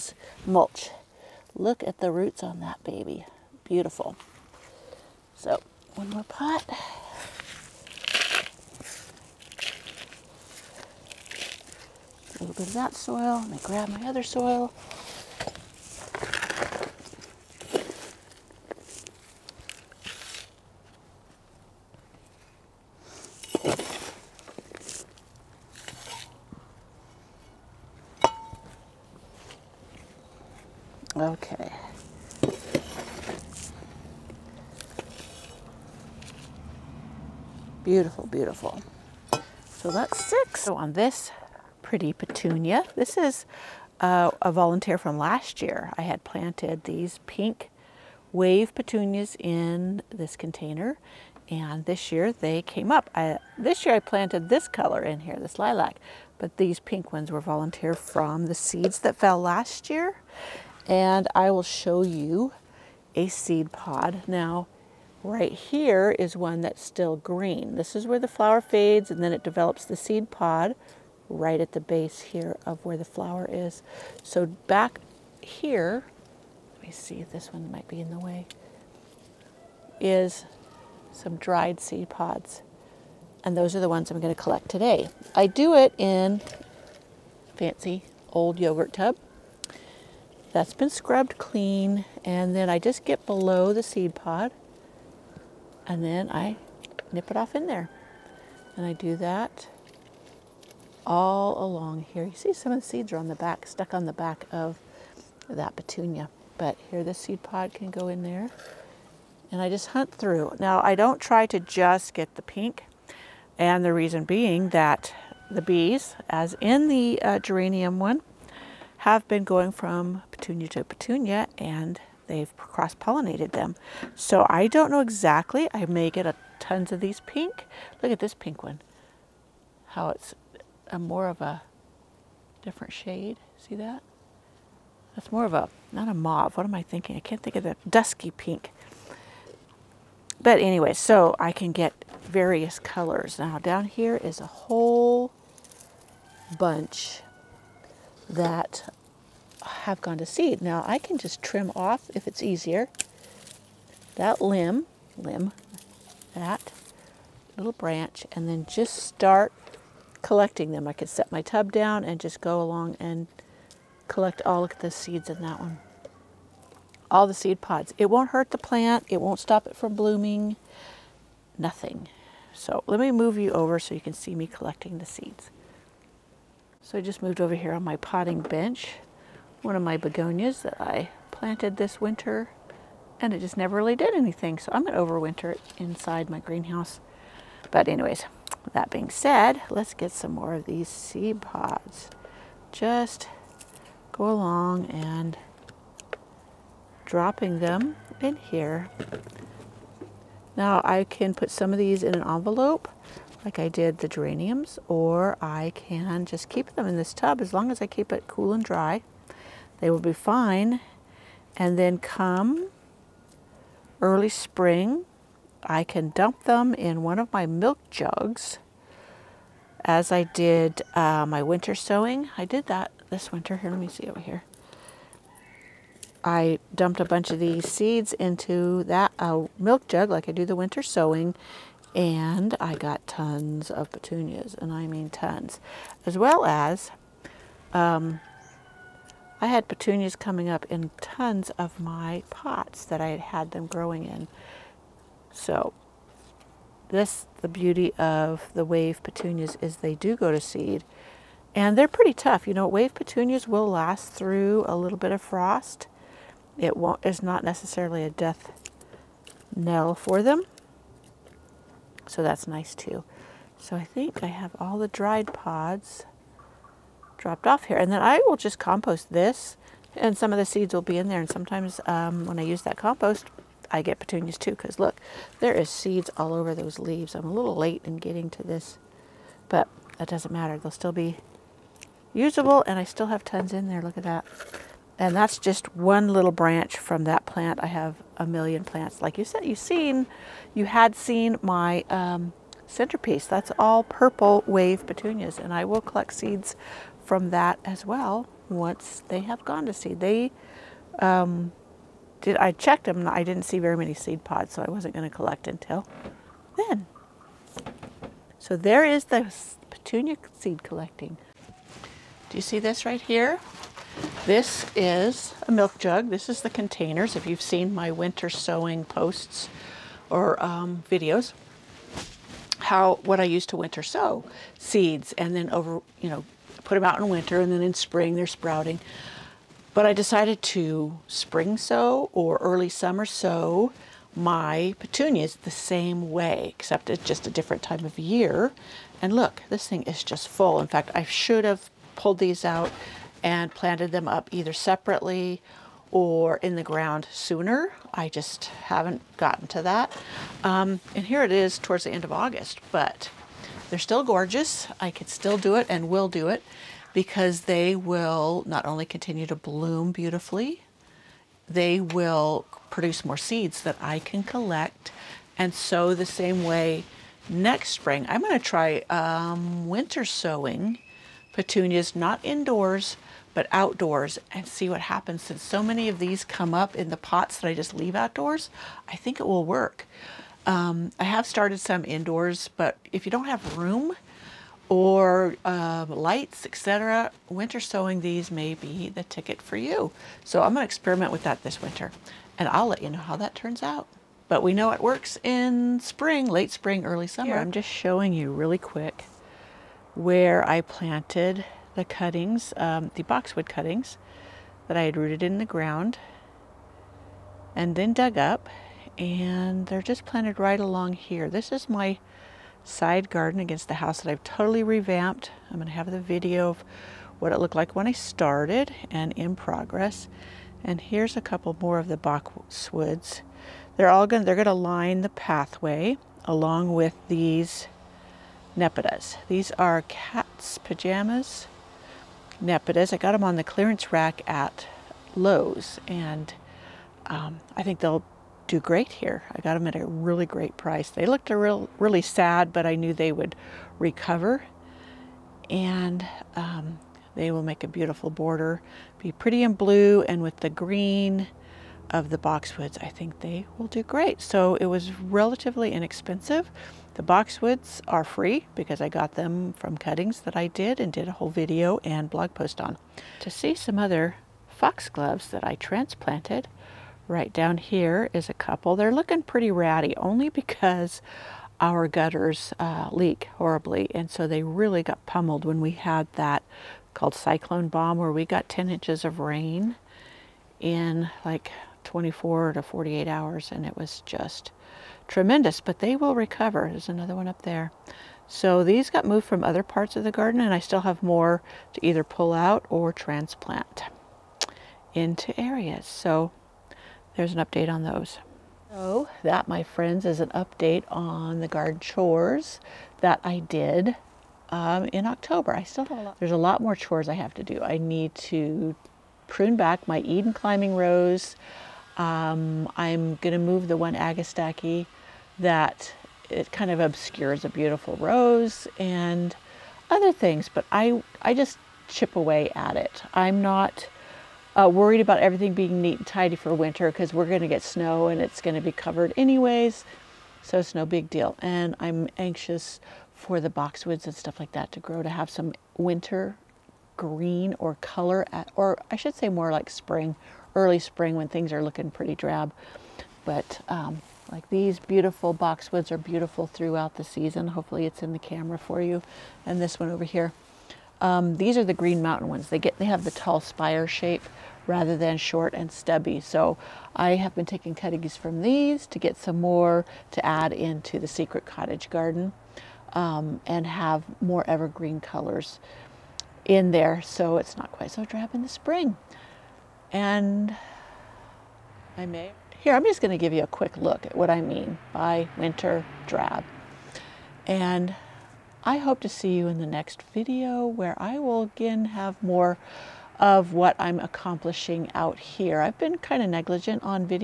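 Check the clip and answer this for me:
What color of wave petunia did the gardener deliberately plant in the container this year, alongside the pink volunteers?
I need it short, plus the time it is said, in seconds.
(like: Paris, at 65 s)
lilac, at 55 s.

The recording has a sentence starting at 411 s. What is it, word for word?
This is my side garden against the house that I've totally revamped.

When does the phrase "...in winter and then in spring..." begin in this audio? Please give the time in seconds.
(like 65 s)
326 s.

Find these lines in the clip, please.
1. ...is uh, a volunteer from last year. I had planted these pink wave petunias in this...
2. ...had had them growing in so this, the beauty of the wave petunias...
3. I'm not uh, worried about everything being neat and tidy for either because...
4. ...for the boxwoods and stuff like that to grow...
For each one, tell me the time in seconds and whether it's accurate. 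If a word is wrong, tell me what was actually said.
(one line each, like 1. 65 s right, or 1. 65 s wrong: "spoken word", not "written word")
1. 43 s right
2. 243 s right
3. 523 s wrong: "winter", not "either"
4. 533 s right.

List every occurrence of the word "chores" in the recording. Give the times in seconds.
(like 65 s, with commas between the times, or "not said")
501 s, 506 s.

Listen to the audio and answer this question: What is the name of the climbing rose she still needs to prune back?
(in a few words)
Eden.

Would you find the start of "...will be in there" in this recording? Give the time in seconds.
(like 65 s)
270 s.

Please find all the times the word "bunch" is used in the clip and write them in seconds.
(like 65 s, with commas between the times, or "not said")
146 s, 227 s.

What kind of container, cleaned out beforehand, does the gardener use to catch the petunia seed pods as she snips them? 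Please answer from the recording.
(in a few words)
yogurt tub.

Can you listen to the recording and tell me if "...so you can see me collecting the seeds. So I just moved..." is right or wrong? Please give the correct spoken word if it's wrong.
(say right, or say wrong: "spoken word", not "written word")
right.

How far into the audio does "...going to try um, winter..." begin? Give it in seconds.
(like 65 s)
368 s.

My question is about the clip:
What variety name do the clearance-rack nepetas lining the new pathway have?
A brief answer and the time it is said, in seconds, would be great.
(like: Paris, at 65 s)
cat's pajamas, at 429 s.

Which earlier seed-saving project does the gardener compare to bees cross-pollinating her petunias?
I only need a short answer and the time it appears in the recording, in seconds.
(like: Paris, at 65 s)
geranium, at 117 s.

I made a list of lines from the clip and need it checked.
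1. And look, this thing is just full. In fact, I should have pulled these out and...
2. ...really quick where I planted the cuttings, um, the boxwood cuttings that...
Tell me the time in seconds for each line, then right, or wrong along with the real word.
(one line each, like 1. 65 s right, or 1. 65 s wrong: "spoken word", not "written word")
1. 339 s right
2. 398 s right.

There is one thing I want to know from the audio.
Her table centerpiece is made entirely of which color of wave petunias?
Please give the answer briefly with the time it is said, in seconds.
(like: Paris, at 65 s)
purple, at 293 s.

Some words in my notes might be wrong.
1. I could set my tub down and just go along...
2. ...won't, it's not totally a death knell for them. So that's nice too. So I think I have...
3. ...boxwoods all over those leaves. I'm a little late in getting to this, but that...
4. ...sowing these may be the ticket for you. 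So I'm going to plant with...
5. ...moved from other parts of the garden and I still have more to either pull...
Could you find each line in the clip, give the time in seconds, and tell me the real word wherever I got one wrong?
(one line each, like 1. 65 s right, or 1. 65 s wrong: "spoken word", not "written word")
1. 160 s right
2. 256 s wrong: "necessarily", not "totally"
3. 275 s wrong: "seeds", not "boxwoods"
4. 387 s wrong: "experiment", not "plant"
5. 489 s right.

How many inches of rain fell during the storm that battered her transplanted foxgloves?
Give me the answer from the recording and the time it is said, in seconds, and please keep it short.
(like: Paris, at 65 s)
10, at 478 s.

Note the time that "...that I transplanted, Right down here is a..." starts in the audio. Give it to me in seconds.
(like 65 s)
465 s.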